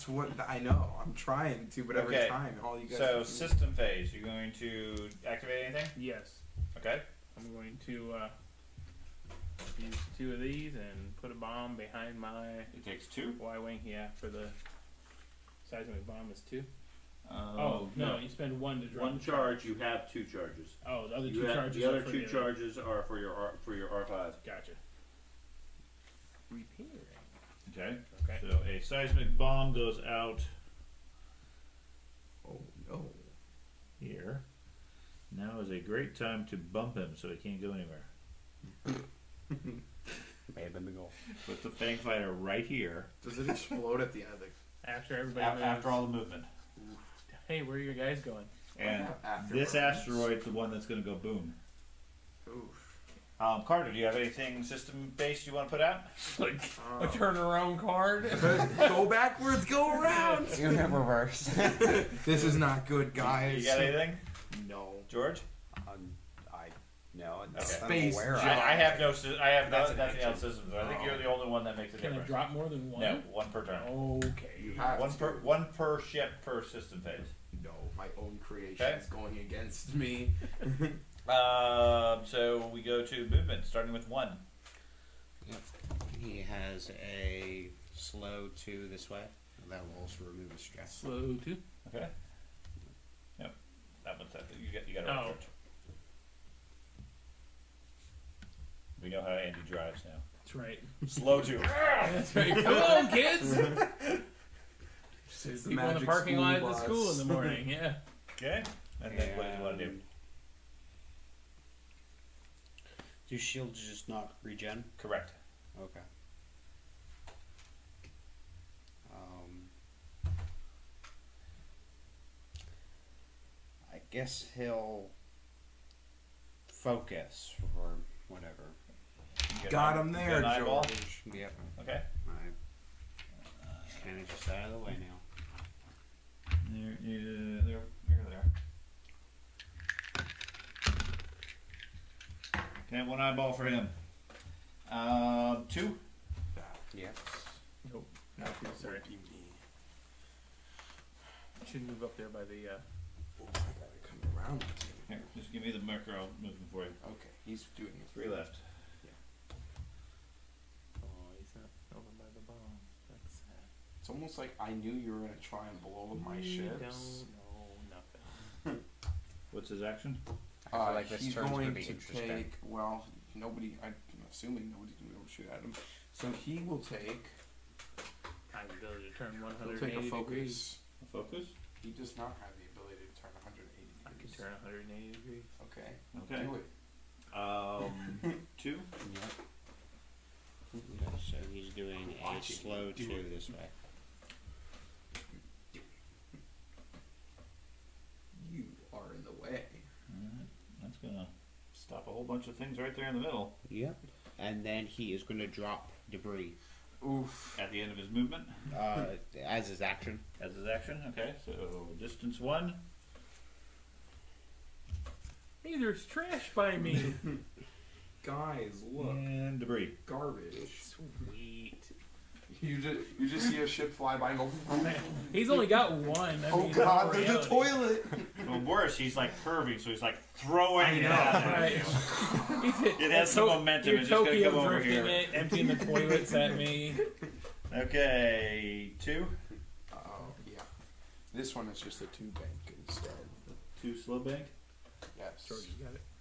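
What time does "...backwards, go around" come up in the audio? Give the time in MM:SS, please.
00:59.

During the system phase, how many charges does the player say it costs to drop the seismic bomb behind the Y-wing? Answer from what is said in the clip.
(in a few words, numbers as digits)
2.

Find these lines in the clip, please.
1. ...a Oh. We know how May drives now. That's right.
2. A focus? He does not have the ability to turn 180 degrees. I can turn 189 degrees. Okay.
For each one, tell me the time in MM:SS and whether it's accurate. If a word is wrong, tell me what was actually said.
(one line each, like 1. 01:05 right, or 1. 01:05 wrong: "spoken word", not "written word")
1. 01:35 wrong: "Andy", not "May"
2. 03:01 wrong: "180", not "189".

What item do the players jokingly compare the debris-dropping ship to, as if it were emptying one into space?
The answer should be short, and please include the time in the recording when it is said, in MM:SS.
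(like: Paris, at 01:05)
a toilet, at 03:47.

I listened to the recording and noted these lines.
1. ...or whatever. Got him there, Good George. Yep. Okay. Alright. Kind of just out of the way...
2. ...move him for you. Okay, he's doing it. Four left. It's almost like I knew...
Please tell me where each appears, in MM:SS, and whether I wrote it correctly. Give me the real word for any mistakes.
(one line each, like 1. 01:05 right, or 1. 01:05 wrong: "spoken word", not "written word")
1. 02:07 right
2. 02:36 wrong: "Three", not "Four".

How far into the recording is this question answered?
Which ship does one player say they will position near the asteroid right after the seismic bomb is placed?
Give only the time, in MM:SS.
00:41.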